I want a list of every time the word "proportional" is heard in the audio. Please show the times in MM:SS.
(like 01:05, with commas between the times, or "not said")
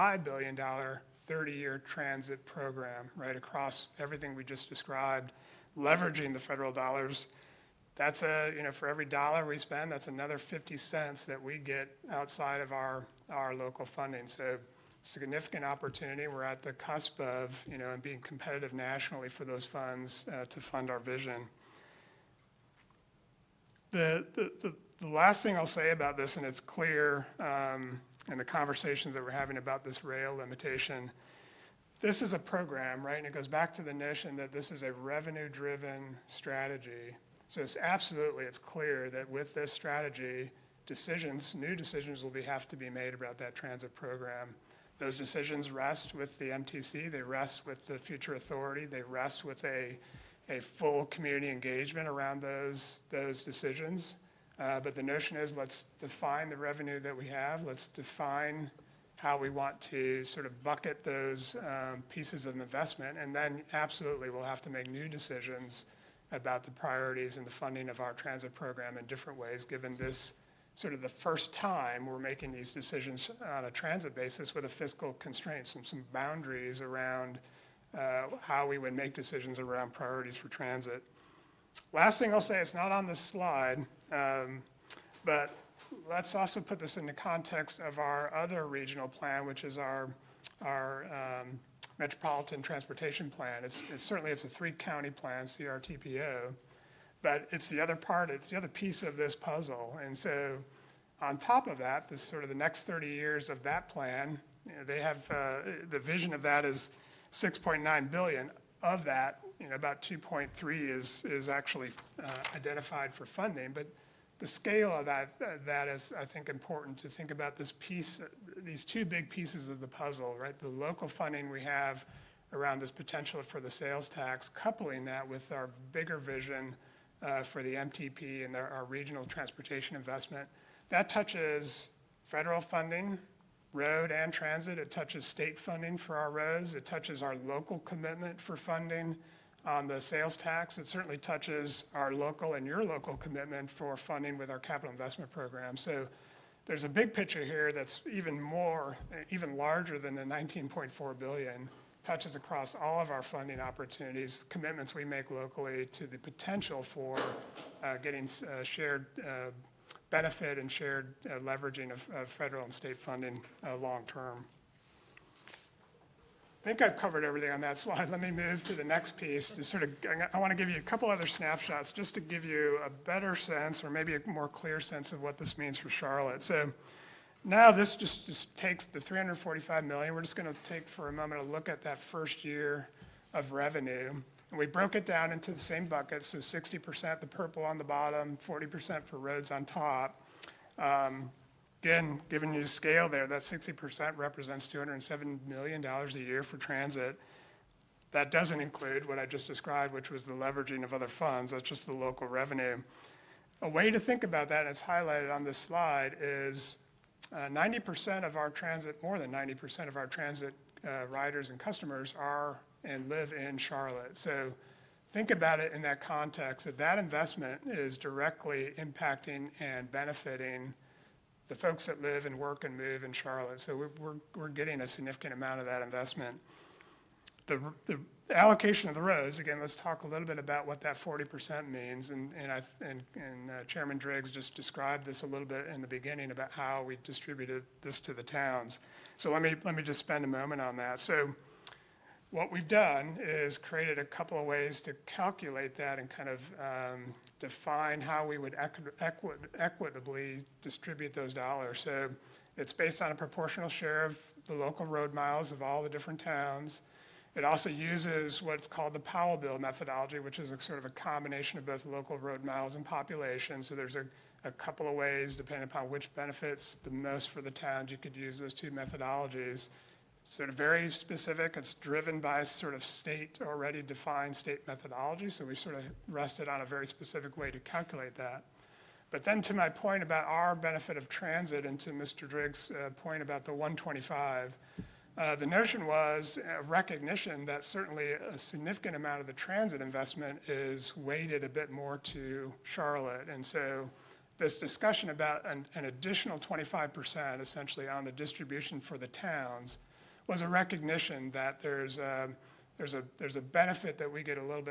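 04:13.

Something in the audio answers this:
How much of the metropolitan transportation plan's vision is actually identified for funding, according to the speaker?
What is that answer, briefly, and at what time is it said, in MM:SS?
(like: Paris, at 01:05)
about 2.3 billion, at 01:50.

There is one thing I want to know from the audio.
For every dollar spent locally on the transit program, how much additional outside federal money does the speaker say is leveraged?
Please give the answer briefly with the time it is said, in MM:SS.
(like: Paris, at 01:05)
50 cents, at 00:10.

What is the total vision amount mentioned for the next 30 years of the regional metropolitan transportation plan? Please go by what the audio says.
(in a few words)
6.9 billion.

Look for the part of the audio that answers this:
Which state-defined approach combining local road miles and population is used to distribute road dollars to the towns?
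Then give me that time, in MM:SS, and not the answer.
04:18.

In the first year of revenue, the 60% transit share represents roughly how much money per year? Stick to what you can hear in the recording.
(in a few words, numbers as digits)
$207 million.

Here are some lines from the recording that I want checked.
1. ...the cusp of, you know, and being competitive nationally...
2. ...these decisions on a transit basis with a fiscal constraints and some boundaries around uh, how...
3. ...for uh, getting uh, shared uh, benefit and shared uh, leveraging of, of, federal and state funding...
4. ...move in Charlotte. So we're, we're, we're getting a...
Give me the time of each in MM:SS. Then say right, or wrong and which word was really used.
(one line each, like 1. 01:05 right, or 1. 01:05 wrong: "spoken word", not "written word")
1. 00:16 right
2. 01:12 right
3. 02:36 right
4. 03:42 right.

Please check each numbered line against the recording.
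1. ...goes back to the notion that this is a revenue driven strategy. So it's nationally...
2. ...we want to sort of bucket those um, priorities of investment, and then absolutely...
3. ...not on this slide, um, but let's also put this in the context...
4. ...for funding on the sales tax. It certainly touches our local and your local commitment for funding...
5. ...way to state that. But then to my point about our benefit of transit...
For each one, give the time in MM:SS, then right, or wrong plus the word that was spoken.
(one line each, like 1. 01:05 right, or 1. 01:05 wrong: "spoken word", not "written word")
1. 00:33 wrong: "absolutely", not "nationally"
2. 00:59 wrong: "pieces", not "priorities"
3. 01:22 right
4. 02:18 right
5. 04:37 wrong: "calculate", not "state".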